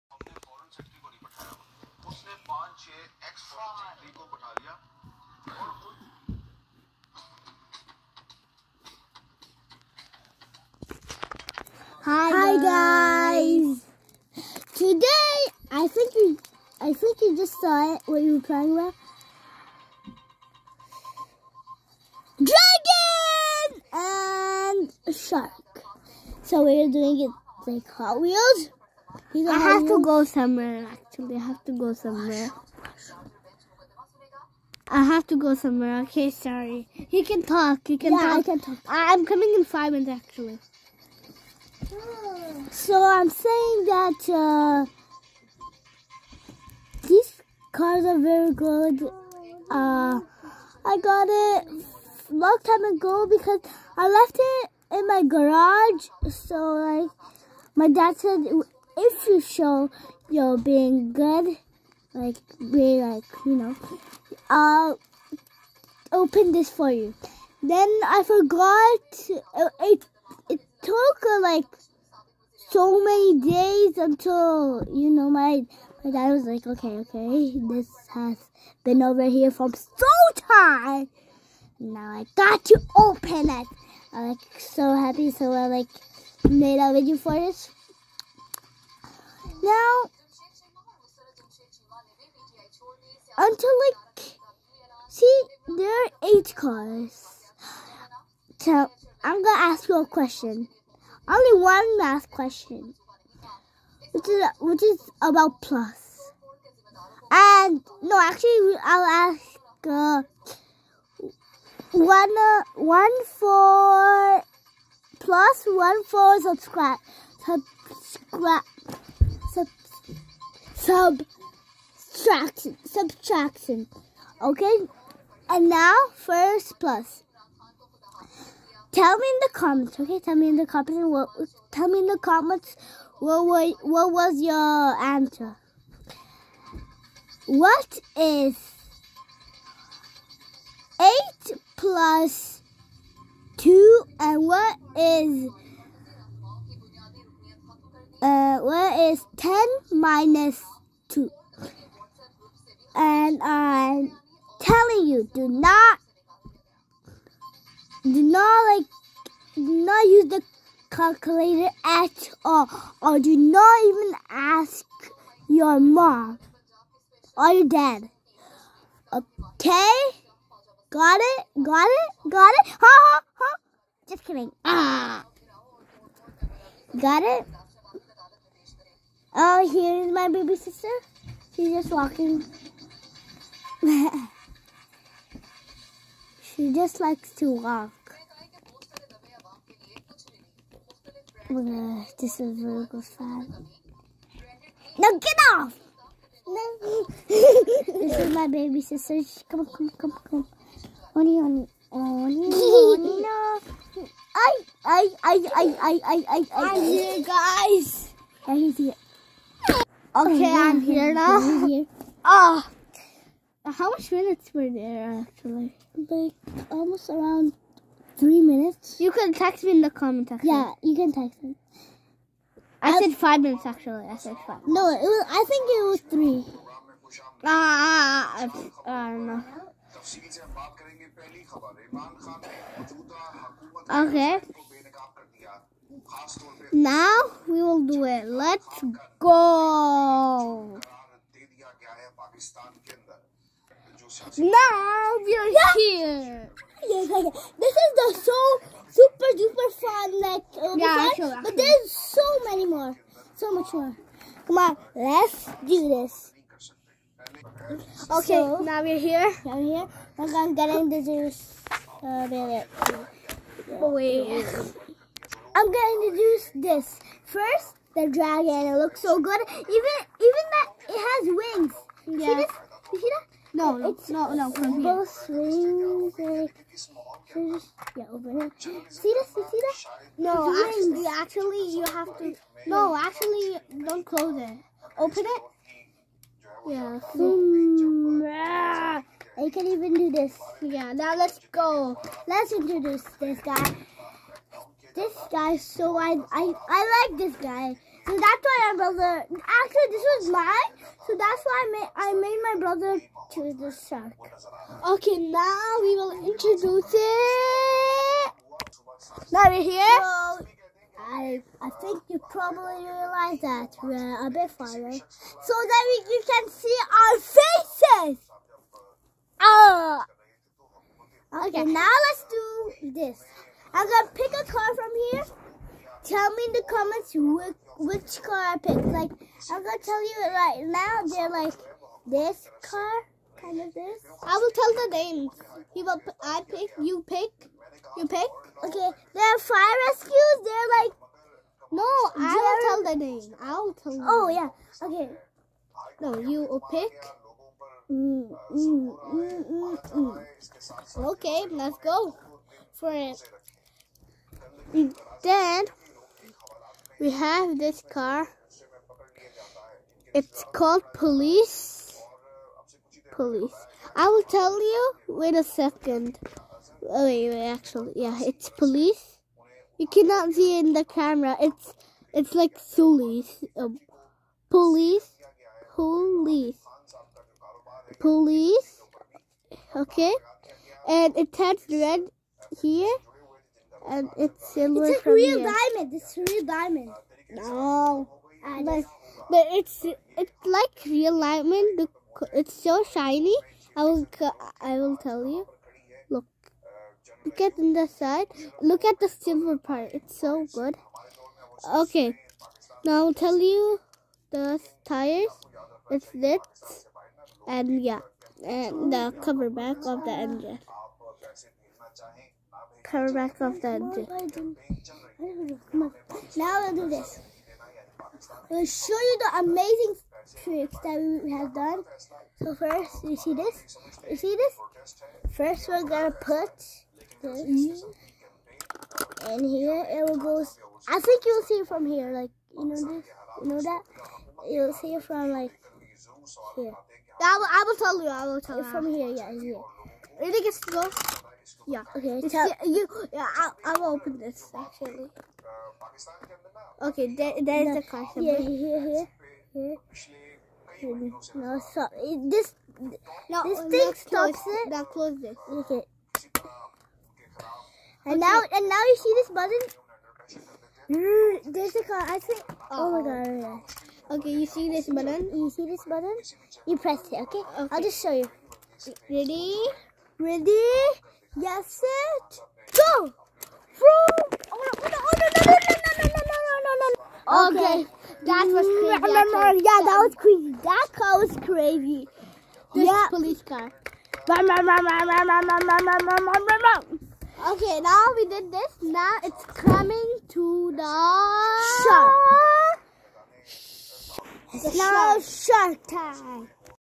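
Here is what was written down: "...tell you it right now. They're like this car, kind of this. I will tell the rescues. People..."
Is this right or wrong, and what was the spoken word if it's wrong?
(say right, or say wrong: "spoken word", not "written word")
wrong: "names", not "rescues".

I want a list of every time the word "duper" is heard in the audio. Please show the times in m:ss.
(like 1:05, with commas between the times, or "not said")
4:09.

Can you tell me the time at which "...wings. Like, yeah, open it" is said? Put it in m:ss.
4:35.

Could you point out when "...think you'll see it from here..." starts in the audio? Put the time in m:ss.
7:10.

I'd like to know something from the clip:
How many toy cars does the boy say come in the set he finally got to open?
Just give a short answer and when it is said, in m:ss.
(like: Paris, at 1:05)
8, at 1:36.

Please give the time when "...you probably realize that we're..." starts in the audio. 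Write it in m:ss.
5:12.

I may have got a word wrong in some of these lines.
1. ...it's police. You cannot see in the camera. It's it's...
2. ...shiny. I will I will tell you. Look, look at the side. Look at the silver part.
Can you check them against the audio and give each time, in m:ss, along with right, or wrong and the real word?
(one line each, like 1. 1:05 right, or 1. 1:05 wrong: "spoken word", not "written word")
1. 6:08 right
2. 6:32 right.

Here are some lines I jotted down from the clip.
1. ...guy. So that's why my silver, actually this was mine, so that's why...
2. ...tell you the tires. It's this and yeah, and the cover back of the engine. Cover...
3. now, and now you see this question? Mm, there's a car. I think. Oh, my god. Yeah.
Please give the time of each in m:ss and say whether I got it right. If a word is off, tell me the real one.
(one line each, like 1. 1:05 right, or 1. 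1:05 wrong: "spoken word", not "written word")
1. 4:57 wrong: "brother", not "silver"
2. 6:43 right
3. 7:38 wrong: "button", not "question".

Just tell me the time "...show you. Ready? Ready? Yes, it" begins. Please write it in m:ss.
7:48.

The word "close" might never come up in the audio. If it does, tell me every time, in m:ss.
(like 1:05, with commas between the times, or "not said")
4:44, 7:20, 7:34.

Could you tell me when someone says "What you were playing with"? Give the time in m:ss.
0:18.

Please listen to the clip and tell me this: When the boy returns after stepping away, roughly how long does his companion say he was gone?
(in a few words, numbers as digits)
3 minutes.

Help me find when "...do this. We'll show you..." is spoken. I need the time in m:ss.
6:56.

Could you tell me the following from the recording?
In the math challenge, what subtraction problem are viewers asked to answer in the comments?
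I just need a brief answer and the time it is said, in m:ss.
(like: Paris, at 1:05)
10 minus 2, at 2:29.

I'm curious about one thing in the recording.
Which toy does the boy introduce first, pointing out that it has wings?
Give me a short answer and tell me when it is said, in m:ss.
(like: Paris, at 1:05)
The dragon, at 4:27.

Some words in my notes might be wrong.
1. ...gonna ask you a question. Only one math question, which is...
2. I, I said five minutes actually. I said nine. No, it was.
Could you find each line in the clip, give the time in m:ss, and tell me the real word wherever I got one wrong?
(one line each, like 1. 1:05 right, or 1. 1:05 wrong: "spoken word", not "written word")
1. 1:39 right
2. 3:42 wrong: "five", not "nine".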